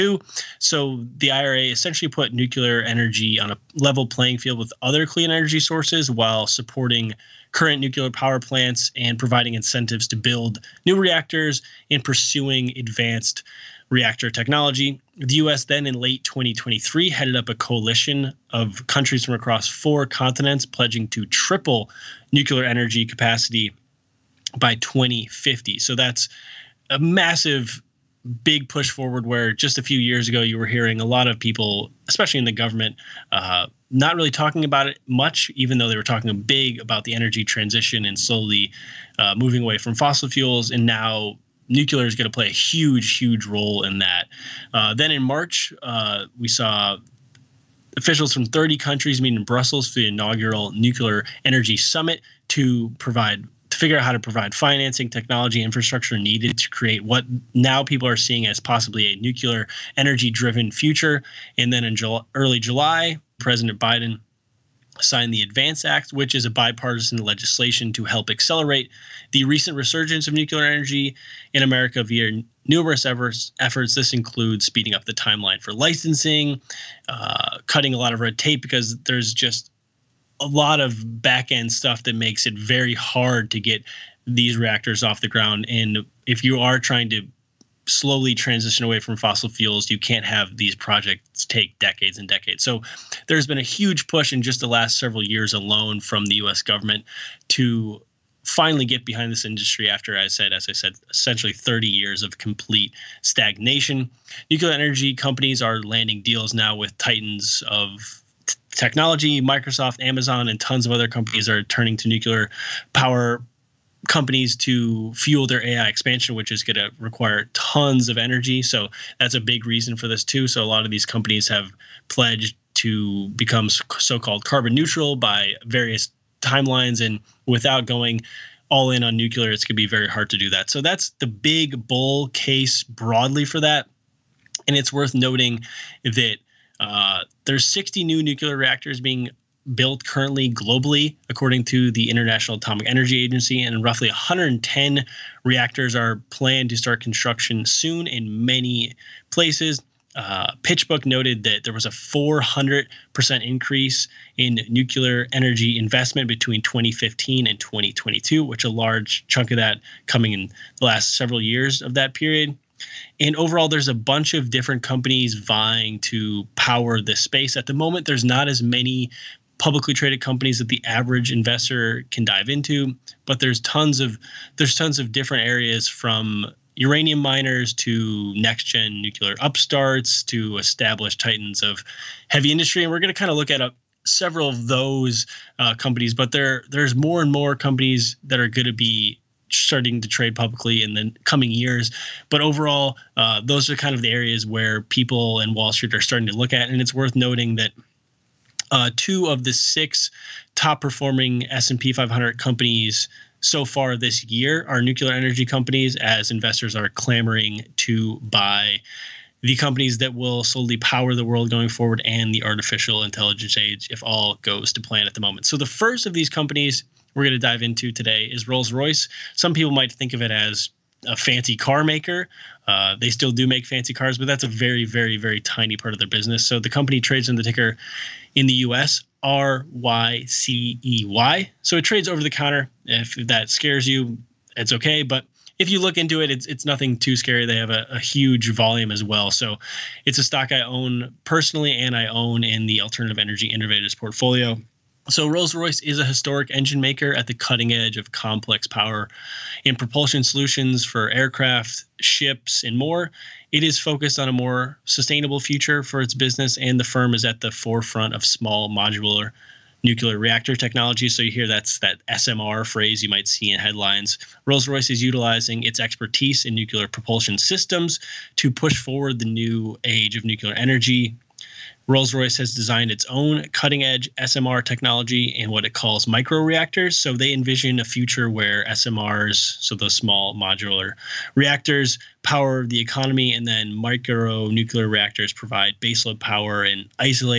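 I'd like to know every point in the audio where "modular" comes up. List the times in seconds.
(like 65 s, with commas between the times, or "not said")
258 s, 280 s.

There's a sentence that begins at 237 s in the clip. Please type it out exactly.
They have a, a huge volume as well.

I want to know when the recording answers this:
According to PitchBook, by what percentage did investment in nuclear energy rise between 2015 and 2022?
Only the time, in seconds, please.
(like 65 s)
151 s.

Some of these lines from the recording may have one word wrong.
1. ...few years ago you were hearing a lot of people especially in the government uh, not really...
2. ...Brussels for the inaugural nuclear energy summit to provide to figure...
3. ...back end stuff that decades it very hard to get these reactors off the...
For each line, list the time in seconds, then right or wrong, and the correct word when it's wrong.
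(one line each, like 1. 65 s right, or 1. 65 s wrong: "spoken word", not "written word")
1. 29 s right
2. 49 s right
3. 81 s wrong: "makes", not "decades".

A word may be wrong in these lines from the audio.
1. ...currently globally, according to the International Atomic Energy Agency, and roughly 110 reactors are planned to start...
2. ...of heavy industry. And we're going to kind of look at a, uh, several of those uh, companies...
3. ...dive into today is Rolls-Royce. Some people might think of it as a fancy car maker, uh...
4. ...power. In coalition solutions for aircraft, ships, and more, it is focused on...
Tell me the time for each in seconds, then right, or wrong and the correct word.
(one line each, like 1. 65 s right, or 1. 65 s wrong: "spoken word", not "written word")
1. 140 s right
2. 181 s right
3. 217 s right
4. 248 s wrong: "propulsion", not "coalition".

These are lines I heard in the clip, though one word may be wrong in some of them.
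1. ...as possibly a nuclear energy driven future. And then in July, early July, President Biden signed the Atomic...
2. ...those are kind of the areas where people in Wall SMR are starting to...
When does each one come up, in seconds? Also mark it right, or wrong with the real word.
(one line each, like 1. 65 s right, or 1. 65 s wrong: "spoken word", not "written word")
1. 58 s wrong: "Advance", not "Atomic"
2. 193 s wrong: "Street", not "SMR".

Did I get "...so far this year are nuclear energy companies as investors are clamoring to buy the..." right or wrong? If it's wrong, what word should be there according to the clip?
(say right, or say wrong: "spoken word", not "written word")
right.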